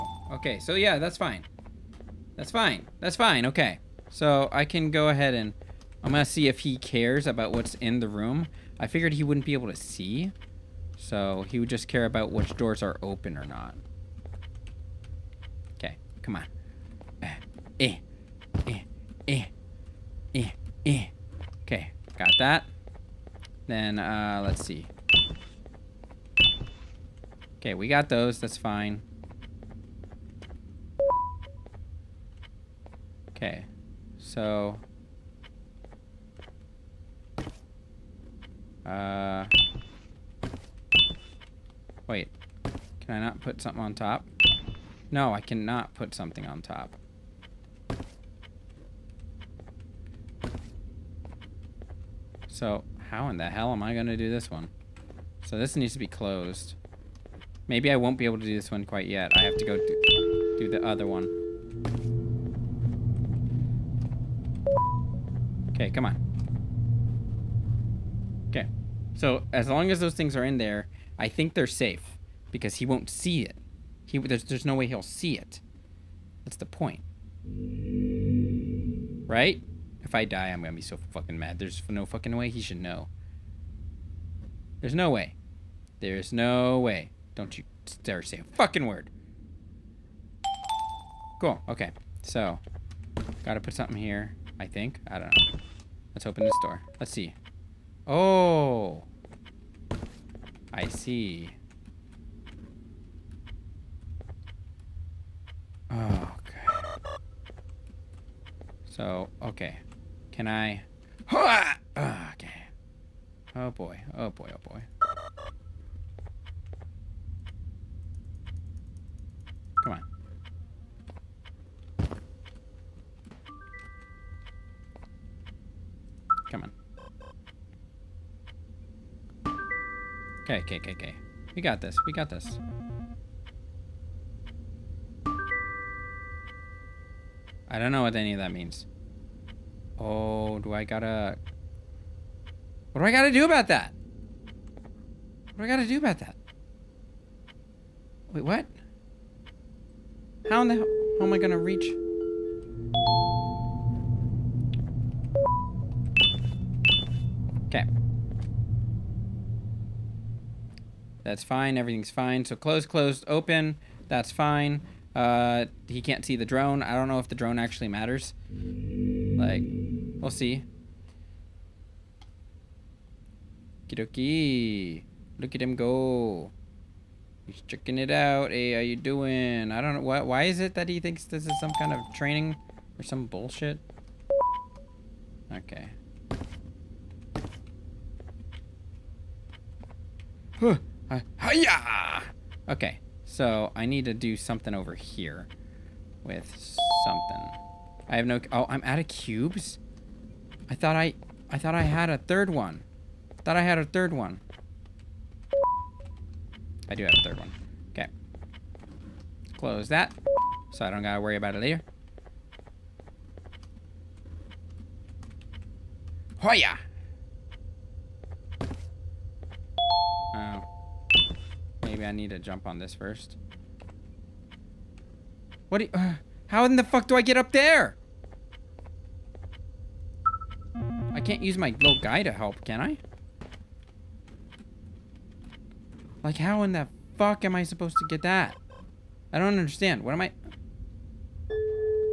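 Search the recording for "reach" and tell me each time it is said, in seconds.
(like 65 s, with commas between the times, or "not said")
151 s.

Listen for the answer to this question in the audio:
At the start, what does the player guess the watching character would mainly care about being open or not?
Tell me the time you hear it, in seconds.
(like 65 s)
12 s.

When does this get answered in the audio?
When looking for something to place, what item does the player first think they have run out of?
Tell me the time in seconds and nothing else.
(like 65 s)
199 s.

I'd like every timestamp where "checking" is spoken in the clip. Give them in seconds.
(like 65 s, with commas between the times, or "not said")
177 s.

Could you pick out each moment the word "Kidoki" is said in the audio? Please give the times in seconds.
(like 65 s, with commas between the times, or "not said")
173 s.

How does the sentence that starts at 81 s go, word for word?
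There's no fucking way he should know.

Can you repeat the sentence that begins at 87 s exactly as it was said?
Don't you dare say a fucking word.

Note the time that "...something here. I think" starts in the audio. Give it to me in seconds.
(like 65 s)
93 s.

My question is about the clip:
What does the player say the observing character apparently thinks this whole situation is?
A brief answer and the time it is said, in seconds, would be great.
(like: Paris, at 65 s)
training, at 182 s.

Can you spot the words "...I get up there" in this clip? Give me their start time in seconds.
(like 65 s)
227 s.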